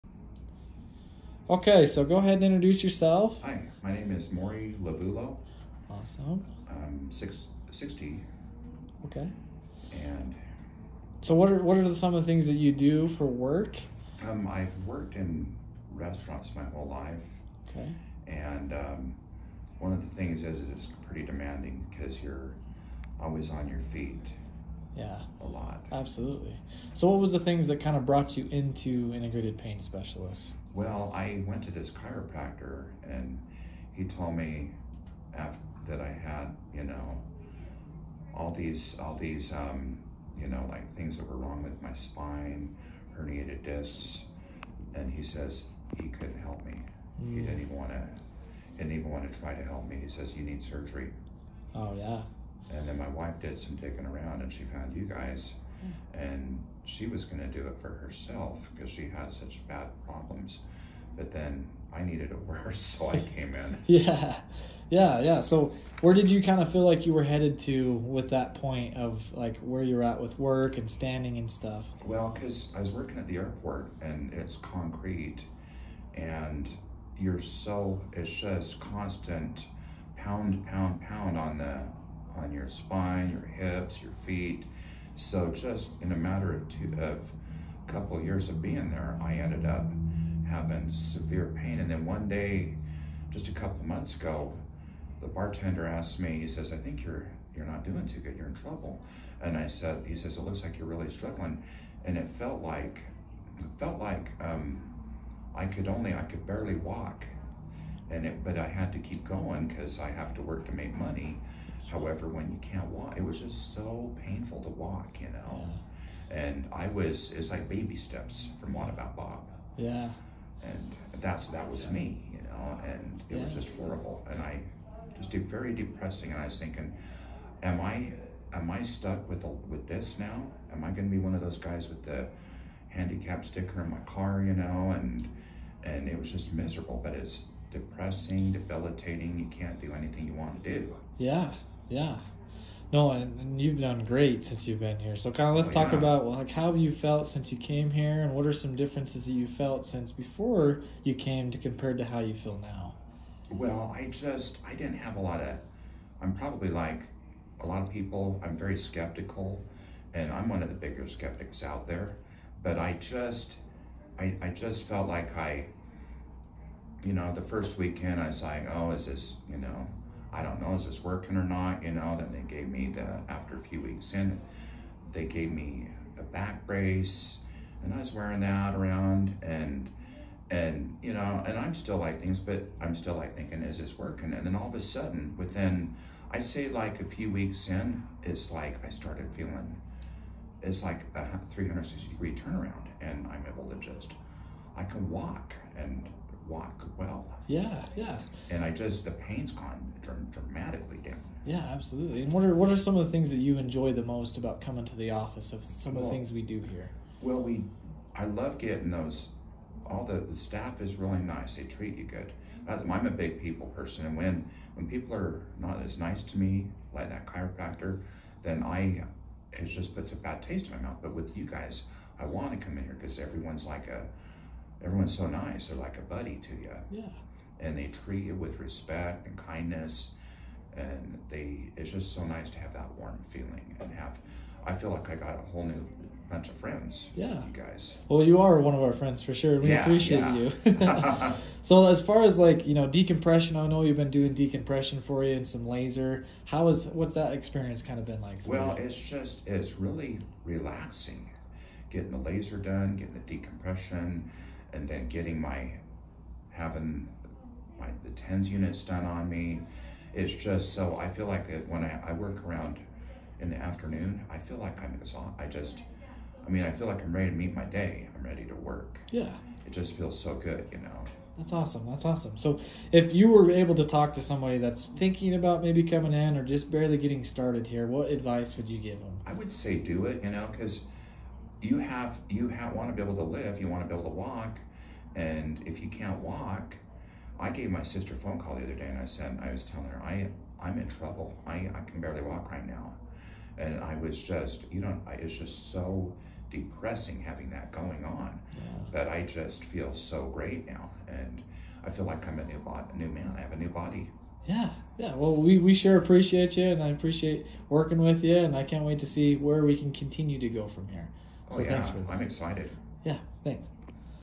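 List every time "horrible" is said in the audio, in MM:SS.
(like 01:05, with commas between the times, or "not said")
02:03.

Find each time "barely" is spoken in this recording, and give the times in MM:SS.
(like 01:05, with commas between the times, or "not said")
01:46, 04:36, 04:51.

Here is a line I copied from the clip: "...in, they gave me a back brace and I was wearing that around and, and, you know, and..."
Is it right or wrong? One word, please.
right.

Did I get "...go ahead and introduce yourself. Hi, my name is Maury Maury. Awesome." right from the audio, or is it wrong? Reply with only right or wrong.
wrong.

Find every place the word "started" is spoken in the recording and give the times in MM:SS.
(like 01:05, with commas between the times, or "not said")
03:08, 04:37.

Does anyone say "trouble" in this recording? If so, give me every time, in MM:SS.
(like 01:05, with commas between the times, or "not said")
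01:38, 04:50.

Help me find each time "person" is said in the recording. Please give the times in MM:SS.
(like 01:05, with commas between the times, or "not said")
03:33.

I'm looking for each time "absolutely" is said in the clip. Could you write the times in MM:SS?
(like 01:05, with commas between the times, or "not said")
00:25, 03:21.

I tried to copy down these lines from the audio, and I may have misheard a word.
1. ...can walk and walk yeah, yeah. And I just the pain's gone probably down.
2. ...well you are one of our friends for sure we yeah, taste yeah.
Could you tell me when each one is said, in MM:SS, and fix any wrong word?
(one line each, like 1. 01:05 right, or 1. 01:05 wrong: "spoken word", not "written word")
1. 03:14 wrong: "dramatically", not "probably"
2. 03:58 wrong: "appreciate", not "taste".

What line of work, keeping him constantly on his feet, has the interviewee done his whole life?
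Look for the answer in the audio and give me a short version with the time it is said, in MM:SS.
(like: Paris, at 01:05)
Restaurants, at 00:15.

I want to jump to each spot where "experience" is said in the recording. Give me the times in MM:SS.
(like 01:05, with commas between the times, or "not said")
04:07.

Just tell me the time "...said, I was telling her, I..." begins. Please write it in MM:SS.
04:49.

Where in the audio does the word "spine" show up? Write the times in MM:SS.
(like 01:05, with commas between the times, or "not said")
00:41, 01:22.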